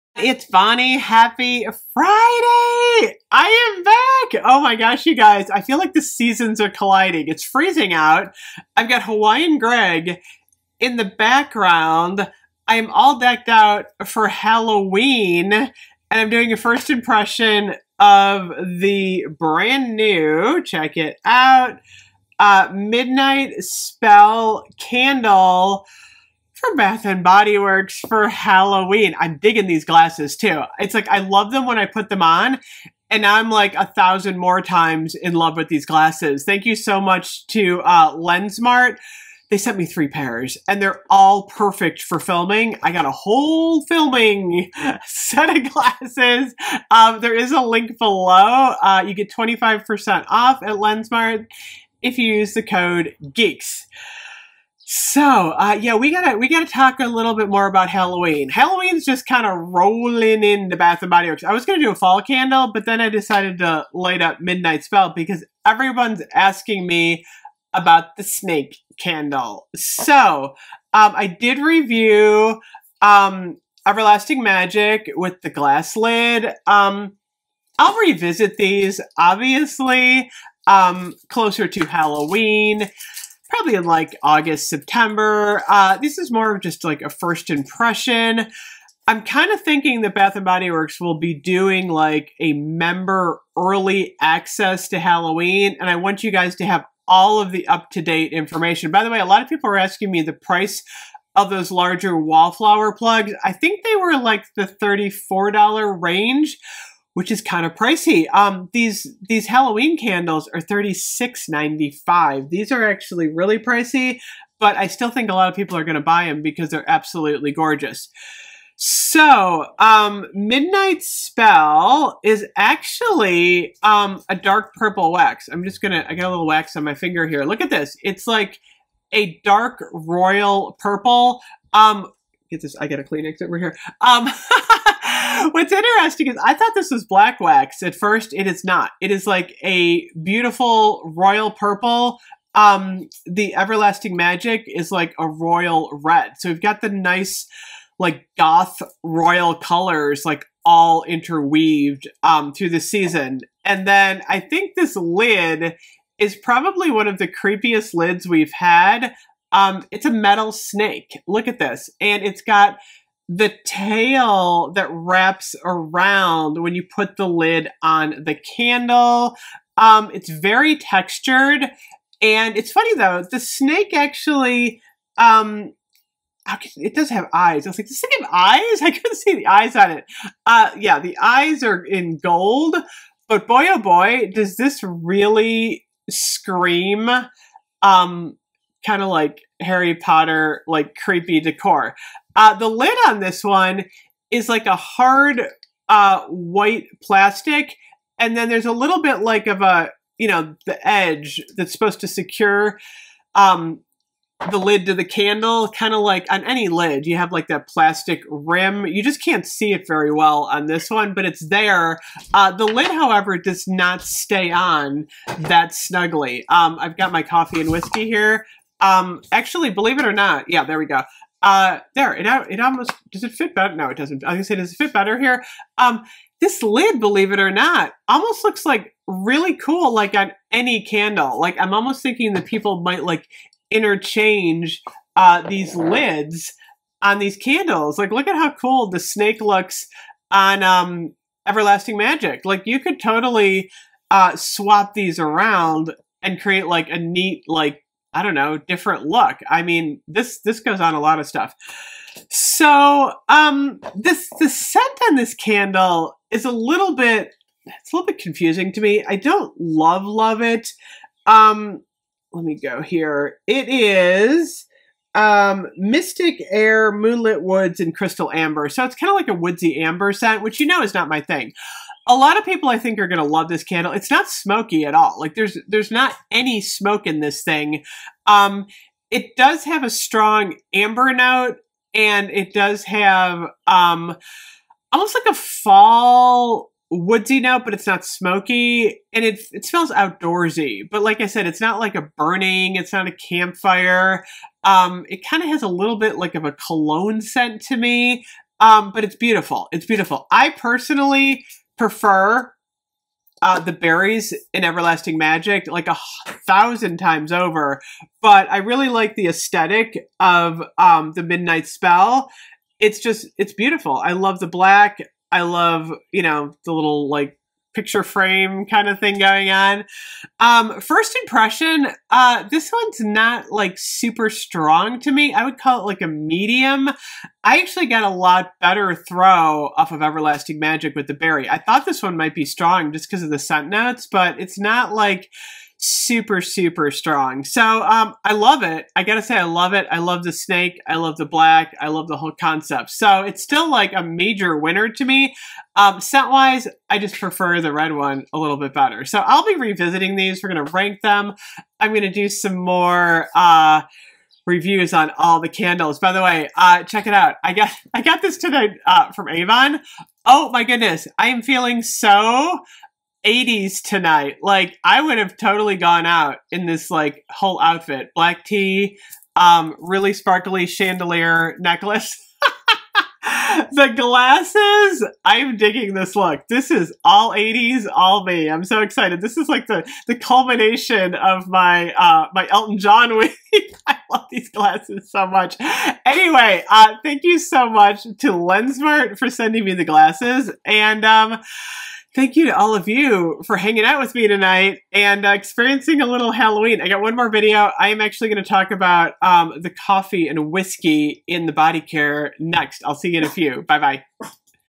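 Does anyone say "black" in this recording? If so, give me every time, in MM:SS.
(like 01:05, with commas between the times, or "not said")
02:17, 05:14, 05:41, 06:08.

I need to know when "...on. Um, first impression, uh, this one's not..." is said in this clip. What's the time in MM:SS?
05:19.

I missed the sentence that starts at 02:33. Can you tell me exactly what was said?
And then I think this lid is probably one of the creepiest lids we've had.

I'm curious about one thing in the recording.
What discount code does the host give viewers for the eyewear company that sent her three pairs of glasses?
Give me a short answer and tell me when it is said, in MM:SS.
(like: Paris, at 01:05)
GEEKS, at 00:53.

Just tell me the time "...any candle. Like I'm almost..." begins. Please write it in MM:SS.
03:50.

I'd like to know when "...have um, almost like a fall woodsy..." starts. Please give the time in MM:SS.
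04:42.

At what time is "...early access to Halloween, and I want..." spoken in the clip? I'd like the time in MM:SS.
01:33.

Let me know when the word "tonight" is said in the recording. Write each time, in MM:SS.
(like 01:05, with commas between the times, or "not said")
06:03, 06:34.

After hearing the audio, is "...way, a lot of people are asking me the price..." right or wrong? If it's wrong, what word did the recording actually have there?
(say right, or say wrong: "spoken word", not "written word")
right.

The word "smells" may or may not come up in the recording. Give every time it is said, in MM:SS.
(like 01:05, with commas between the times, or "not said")
04:49.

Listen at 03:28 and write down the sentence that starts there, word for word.
You just can't see it very well on this one, but it's there.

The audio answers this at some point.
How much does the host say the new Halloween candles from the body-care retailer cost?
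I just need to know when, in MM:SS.
01:50.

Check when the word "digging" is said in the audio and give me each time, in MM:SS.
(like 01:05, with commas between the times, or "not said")
00:29, 06:15.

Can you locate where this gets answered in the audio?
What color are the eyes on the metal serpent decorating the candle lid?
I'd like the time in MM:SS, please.
03:02.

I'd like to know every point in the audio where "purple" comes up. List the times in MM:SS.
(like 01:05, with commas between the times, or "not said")
02:04, 02:10, 02:21.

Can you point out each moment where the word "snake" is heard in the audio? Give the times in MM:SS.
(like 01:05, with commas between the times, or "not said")
01:08, 02:40, 02:53, 03:58, 05:40.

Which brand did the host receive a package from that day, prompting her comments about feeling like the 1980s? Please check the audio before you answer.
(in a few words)
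Avon.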